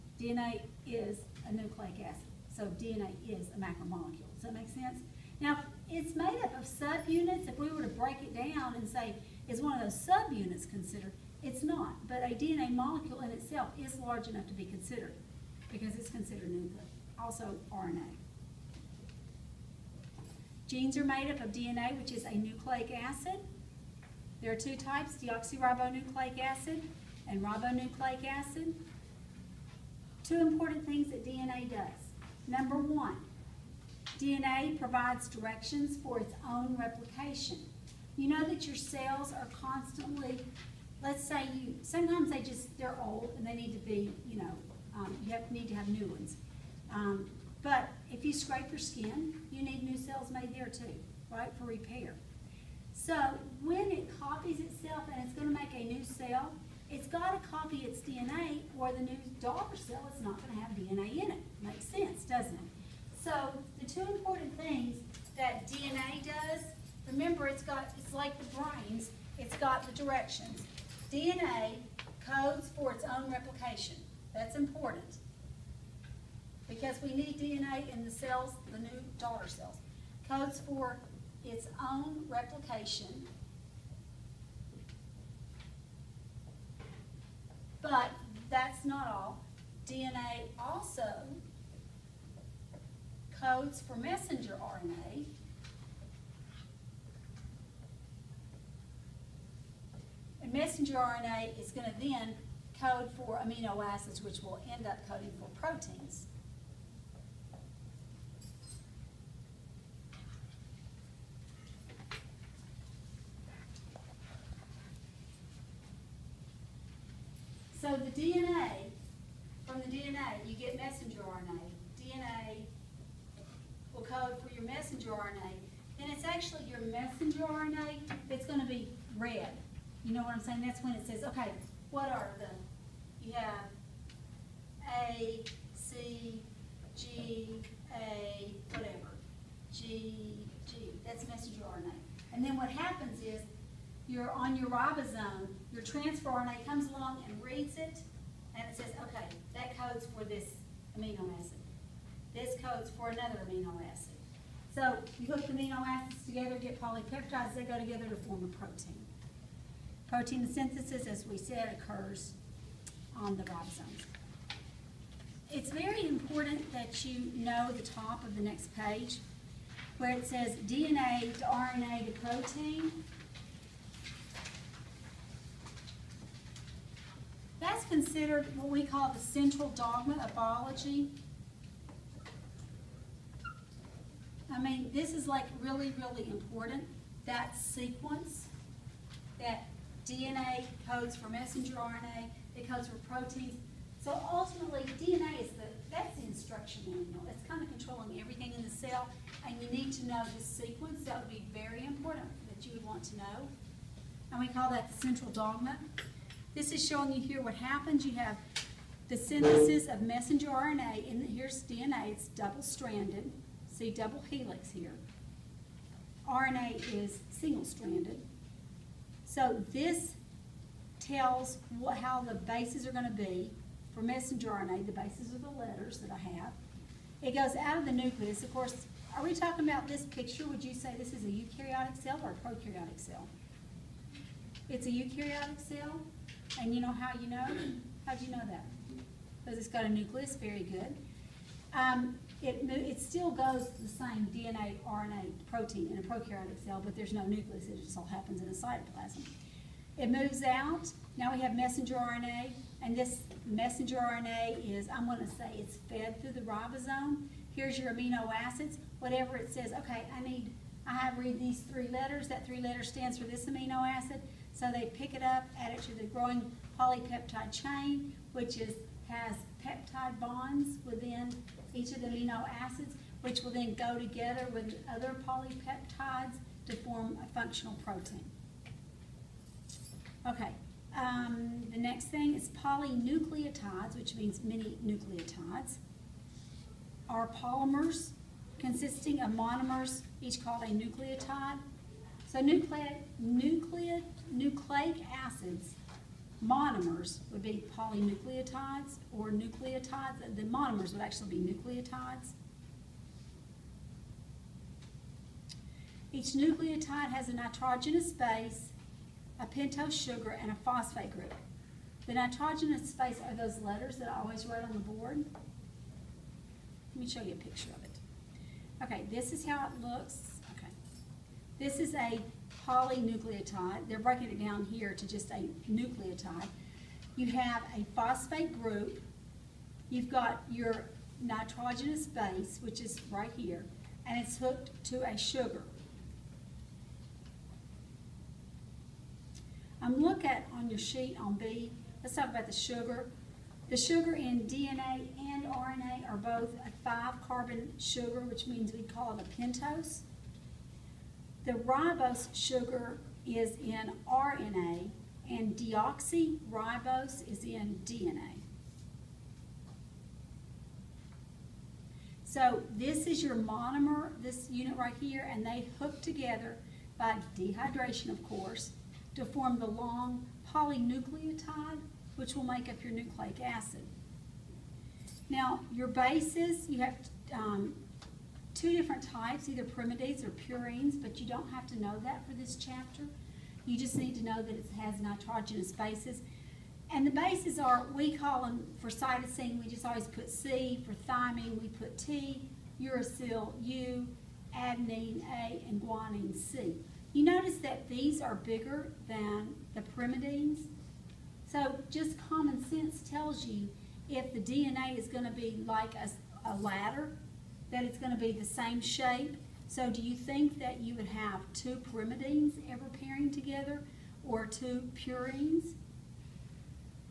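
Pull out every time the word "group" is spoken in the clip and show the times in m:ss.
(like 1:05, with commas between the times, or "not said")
5:11, 5:28.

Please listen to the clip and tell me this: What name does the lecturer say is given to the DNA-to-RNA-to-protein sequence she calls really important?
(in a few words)
central dogma of biology.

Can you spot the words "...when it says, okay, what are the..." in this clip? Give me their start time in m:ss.
2:10.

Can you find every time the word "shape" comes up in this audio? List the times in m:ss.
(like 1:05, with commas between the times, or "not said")
6:48.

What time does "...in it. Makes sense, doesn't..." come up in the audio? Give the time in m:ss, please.
1:01.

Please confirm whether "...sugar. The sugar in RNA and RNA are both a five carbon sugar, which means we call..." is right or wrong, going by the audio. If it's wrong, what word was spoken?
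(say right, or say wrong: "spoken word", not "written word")
wrong: "DNA", not "RNA".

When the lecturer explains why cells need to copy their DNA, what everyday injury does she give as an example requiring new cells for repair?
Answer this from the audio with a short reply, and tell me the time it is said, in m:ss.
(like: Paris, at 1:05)
scrape your skin, at 0:48.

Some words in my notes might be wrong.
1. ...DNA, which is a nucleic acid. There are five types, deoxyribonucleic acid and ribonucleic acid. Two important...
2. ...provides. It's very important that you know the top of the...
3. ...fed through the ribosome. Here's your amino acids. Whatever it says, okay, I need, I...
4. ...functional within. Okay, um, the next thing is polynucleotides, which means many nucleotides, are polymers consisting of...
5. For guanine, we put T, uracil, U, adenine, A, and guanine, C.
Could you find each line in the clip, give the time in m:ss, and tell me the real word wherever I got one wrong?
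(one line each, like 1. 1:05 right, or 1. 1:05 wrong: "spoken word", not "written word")
1. 0:21 wrong: "two", not "five"
2. 2:43 wrong: "ribosomes", not "provides"
3. 4:15 right
4. 4:37 wrong: "protein", not "within"
5. 6:30 wrong: "thymine", not "guanine".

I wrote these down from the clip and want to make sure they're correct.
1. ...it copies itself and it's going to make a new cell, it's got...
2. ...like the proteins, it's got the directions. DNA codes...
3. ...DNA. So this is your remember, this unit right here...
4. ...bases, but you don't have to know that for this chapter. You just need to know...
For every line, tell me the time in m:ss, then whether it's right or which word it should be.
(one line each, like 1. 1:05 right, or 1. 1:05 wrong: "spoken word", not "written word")
1. 0:53 right
2. 1:08 wrong: "brains", not "proteins"
3. 5:57 wrong: "monomer", not "remember"
4. 6:20 wrong: "purines", not "bases".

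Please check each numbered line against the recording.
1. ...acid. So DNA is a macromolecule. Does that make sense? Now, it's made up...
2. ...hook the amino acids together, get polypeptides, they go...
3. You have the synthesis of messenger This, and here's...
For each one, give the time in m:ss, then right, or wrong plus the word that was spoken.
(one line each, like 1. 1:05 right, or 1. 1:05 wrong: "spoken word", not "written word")
1. 0:02 right
2. 2:35 right
3. 3:28 wrong: "RNA", not "This".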